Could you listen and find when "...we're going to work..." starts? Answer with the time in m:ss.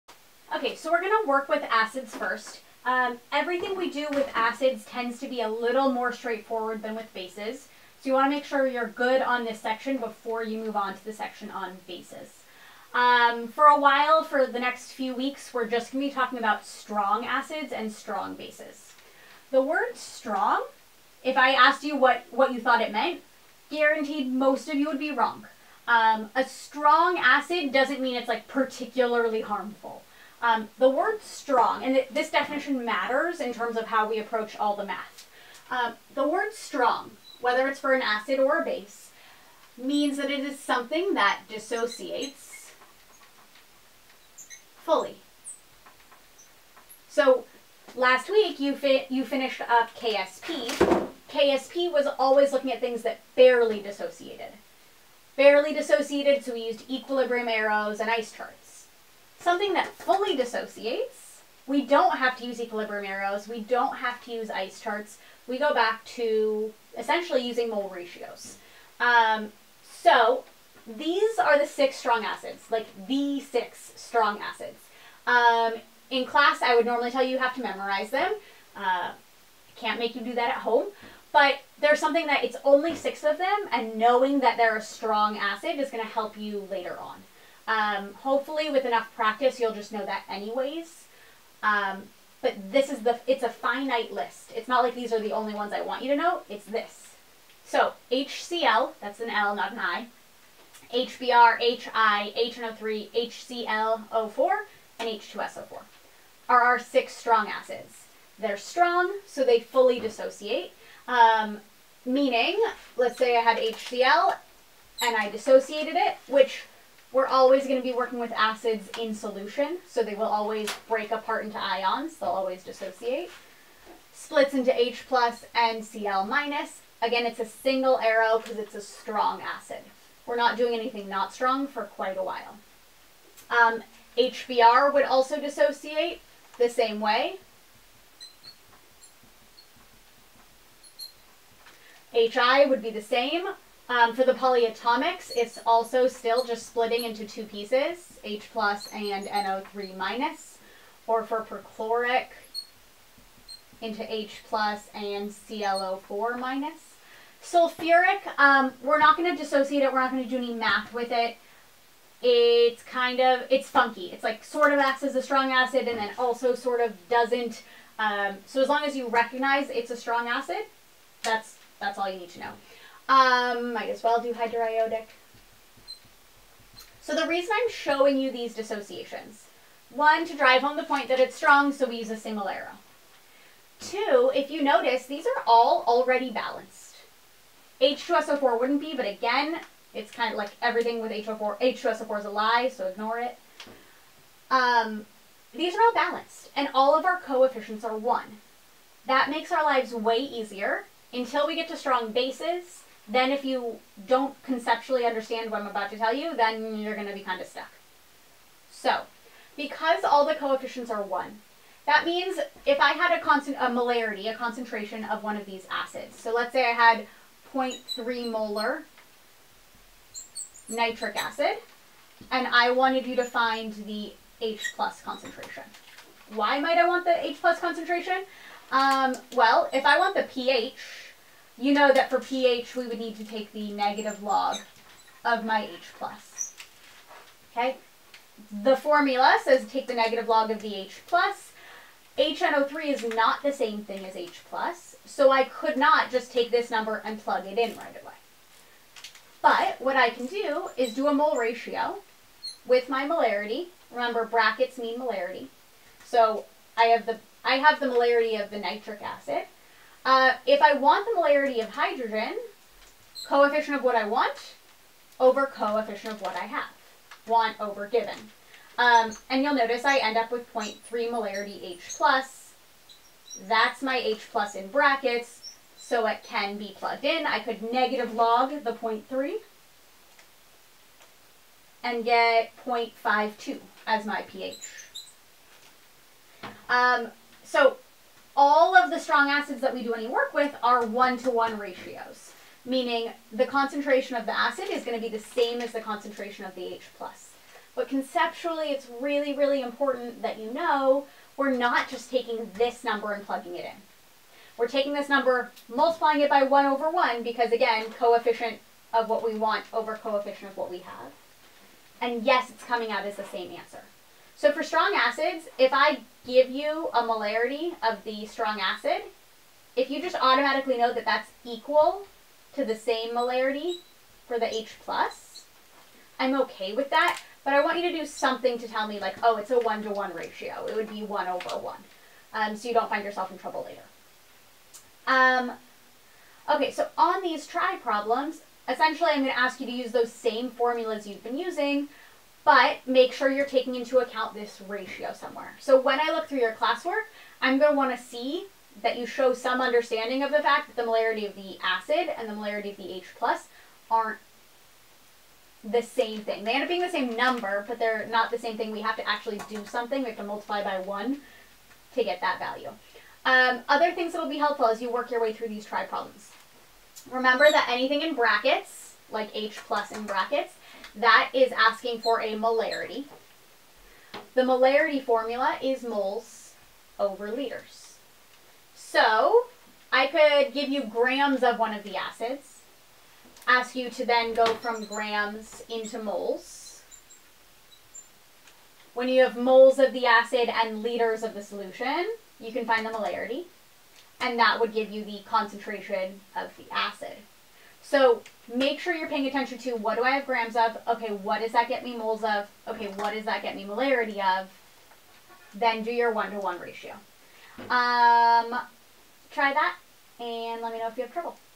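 0:00.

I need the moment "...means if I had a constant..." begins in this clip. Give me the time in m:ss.
3:32.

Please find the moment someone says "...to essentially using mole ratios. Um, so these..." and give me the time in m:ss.
1:06.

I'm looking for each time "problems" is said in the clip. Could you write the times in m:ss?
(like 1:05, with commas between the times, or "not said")
5:37, 6:05.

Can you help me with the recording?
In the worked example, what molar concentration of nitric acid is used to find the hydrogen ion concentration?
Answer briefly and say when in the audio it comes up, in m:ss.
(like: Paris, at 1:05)
0.3 molar, at 3:37.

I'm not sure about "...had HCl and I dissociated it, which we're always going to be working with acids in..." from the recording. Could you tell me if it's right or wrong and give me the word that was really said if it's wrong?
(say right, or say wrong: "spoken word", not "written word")
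right.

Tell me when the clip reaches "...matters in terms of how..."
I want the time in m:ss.
0:32.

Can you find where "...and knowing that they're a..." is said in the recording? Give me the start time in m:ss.
1:23.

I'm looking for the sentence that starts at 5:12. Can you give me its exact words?
And yes, it's coming out as the same answer.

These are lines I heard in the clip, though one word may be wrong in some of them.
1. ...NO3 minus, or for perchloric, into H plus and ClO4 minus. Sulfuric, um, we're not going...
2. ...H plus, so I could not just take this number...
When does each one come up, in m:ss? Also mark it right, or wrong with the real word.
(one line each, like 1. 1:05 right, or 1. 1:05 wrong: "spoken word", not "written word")
1. 2:29 right
2. 4:04 right.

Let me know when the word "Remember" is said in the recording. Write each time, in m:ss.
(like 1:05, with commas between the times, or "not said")
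4:13, 6:07.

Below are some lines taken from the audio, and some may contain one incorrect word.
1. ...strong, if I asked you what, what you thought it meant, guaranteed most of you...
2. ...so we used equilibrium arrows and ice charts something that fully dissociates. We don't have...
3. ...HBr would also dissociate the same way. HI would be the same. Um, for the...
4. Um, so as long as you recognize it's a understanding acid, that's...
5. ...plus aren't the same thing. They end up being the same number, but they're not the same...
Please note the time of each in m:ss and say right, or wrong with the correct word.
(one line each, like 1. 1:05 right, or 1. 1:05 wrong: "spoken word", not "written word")
1. 0:19 right
2. 0:56 right
3. 2:14 right
4. 2:47 wrong: "strong", not "understanding"
5. 5:53 right.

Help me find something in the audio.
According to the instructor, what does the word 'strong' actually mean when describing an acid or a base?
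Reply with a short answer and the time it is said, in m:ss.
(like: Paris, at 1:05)
dissociates fully, at 0:41.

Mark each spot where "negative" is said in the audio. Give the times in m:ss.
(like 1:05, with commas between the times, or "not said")
3:53, 3:59, 4:37.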